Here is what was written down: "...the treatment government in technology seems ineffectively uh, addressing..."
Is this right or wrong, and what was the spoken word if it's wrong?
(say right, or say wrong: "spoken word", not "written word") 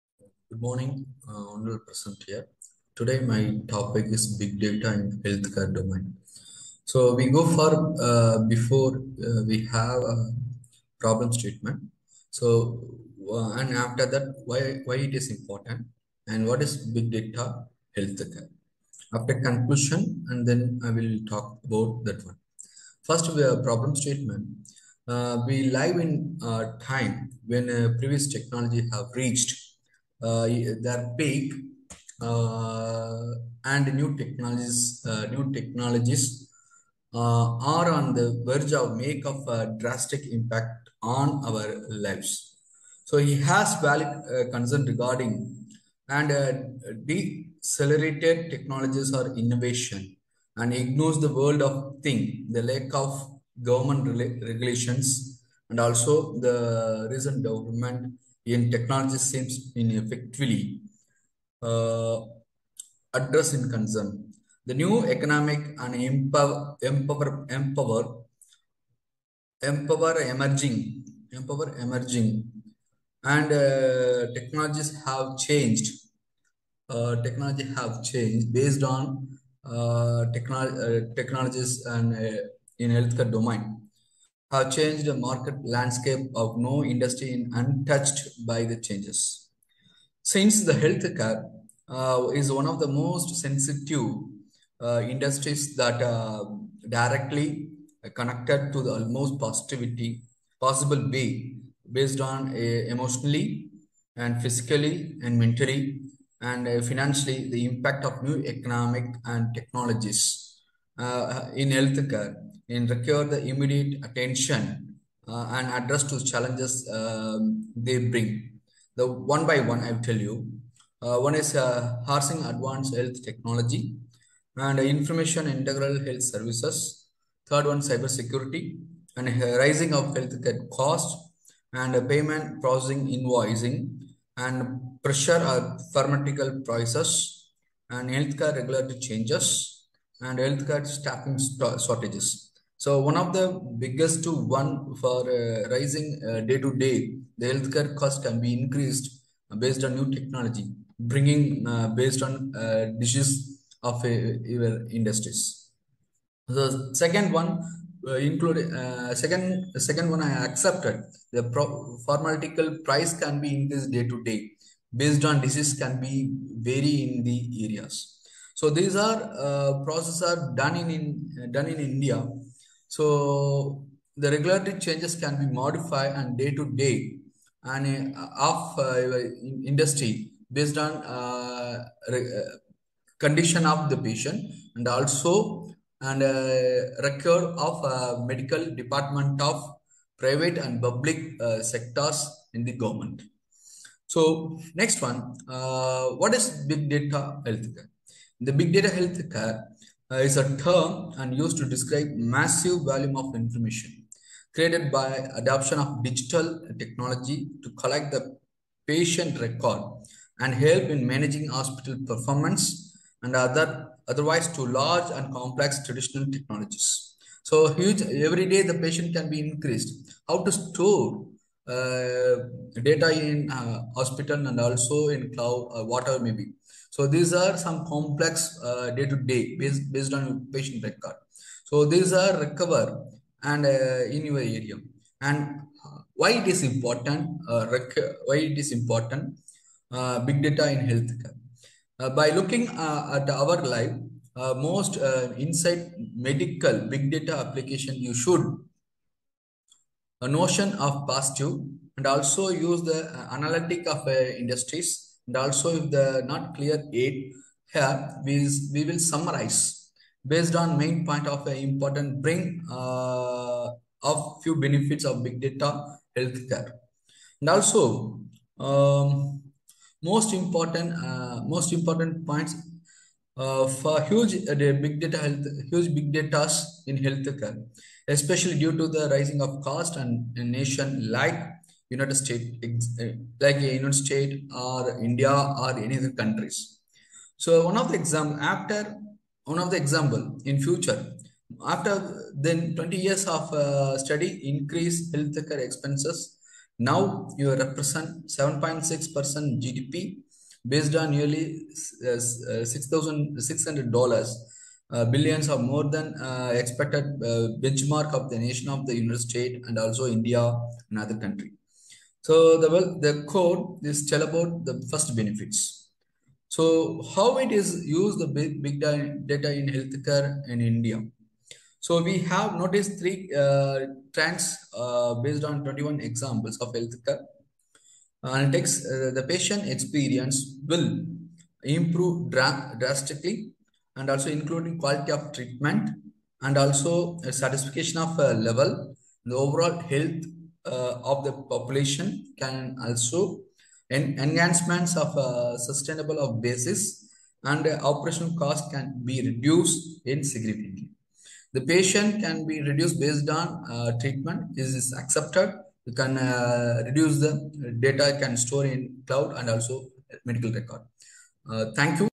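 wrong: "recent", not "treatment".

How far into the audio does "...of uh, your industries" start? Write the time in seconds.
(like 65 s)
153 s.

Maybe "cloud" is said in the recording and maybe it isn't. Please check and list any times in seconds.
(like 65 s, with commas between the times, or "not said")
225 s, 359 s.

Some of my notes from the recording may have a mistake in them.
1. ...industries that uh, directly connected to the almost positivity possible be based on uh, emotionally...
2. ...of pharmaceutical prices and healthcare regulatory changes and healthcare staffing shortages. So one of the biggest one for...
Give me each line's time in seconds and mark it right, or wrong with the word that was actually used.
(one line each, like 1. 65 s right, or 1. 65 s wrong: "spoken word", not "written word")
1. 95 s right
2. 135 s right.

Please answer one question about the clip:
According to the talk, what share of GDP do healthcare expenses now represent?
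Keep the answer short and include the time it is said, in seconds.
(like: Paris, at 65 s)
7.6%, at 298 s.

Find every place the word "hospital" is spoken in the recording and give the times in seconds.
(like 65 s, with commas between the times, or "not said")
211 s, 223 s.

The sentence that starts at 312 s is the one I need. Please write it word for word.
So the well, the code is tell about the first benefits.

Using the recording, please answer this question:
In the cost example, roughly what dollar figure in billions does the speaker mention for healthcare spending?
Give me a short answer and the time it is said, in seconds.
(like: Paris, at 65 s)
$6,600 billion, at 302 s.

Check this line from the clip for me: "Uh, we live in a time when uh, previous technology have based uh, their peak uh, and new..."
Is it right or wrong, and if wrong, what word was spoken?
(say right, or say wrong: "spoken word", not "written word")
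wrong: "reached", not "based".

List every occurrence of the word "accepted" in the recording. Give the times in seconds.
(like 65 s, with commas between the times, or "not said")
160 s, 354 s.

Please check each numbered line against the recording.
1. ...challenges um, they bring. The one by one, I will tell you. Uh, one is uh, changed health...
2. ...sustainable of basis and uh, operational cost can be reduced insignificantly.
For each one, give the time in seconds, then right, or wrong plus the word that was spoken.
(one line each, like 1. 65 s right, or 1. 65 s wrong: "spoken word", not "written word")
1. 116 s wrong: "advanced", not "changed"
2. 345 s right.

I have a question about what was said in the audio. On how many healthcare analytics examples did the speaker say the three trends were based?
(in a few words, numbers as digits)
21.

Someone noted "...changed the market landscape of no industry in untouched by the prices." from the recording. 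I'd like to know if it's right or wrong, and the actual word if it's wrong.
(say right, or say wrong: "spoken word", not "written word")
wrong: "changes", not "prices".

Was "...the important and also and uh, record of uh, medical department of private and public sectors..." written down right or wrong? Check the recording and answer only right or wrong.
wrong.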